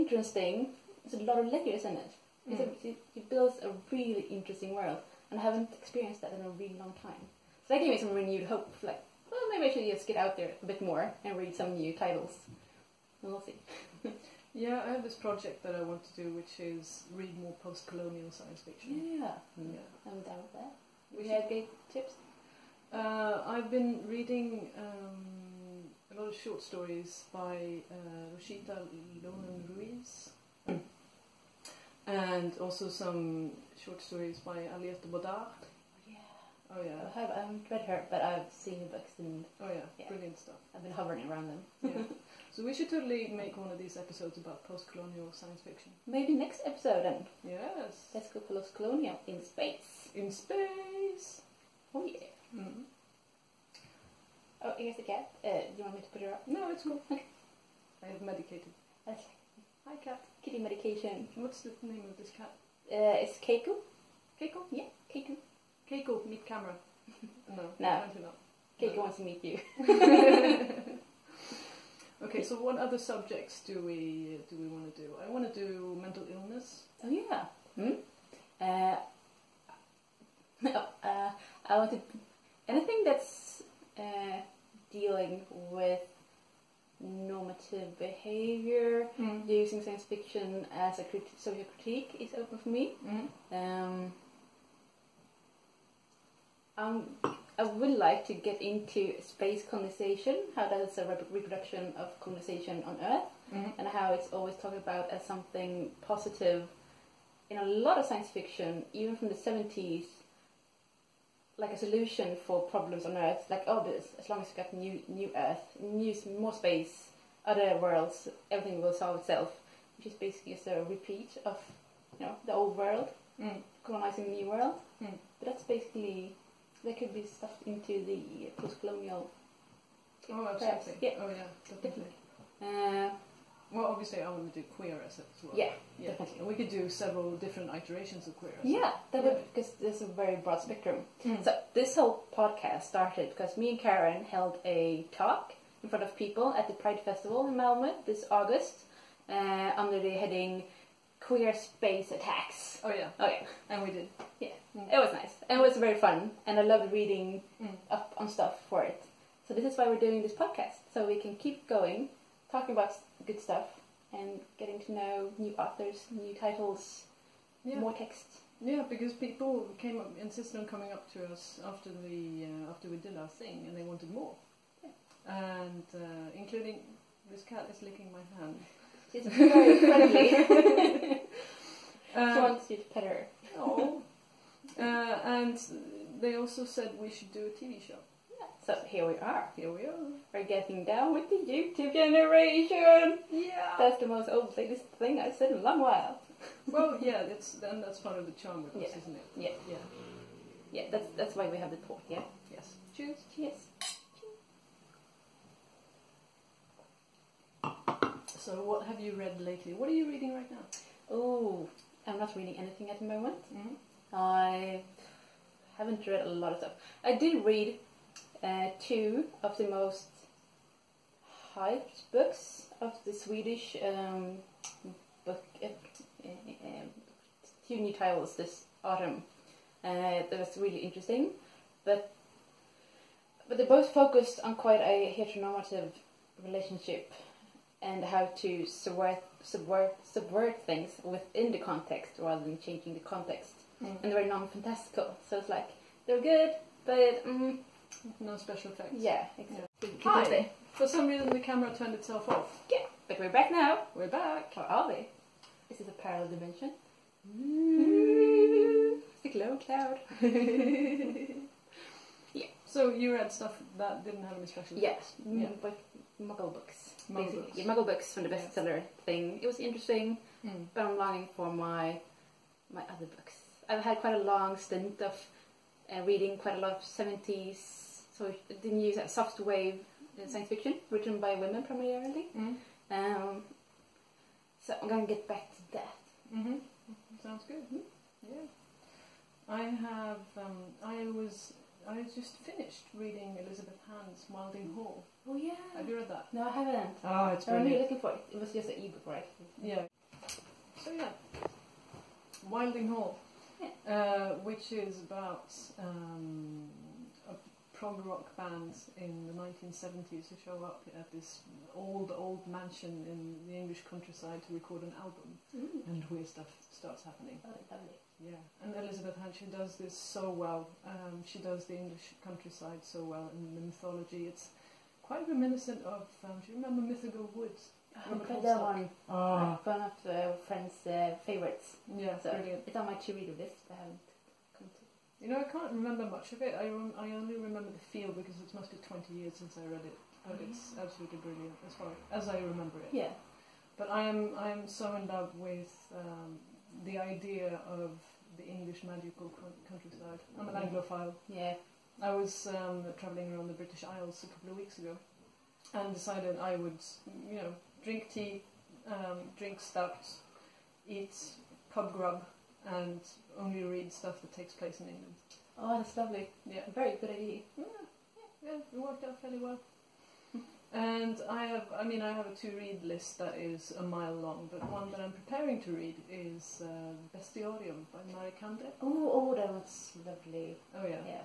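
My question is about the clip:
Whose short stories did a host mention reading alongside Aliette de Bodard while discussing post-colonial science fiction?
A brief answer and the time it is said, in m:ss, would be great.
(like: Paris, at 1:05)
Rosita Lonan Ruiz, at 0:28.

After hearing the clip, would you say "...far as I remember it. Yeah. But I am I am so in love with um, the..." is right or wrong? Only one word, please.
right.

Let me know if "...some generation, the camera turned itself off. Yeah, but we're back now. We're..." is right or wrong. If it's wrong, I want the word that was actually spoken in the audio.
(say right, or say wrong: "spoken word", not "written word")
wrong: "reason", not "generation".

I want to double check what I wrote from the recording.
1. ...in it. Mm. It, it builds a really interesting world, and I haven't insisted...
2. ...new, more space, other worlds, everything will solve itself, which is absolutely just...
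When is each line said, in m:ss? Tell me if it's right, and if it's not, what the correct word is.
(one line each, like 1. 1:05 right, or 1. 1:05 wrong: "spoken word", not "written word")
1. 0:01 wrong: "experienced", not "insisted"
2. 1:55 wrong: "basically", not "absolutely".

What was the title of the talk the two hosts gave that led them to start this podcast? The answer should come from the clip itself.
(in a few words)
Queer Space Attacks.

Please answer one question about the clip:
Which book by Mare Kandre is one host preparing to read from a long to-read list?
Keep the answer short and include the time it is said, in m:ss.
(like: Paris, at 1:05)
Bestiarium, at 6:17.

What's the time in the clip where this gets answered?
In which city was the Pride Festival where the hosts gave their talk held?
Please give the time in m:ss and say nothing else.
2:27.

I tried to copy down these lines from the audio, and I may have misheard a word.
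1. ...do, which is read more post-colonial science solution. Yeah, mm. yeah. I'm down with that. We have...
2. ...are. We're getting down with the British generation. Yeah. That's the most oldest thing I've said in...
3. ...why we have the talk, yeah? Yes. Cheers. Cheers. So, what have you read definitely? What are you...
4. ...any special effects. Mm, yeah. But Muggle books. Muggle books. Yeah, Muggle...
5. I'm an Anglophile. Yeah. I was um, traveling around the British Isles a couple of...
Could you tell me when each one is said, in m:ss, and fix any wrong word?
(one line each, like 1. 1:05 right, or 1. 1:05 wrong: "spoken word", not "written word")
1. 0:16 wrong: "fiction", not "solution"
2. 3:09 wrong: "YouTube", not "British"
3. 3:21 wrong: "lately", not "definitely"
4. 4:24 right
5. 5:50 right.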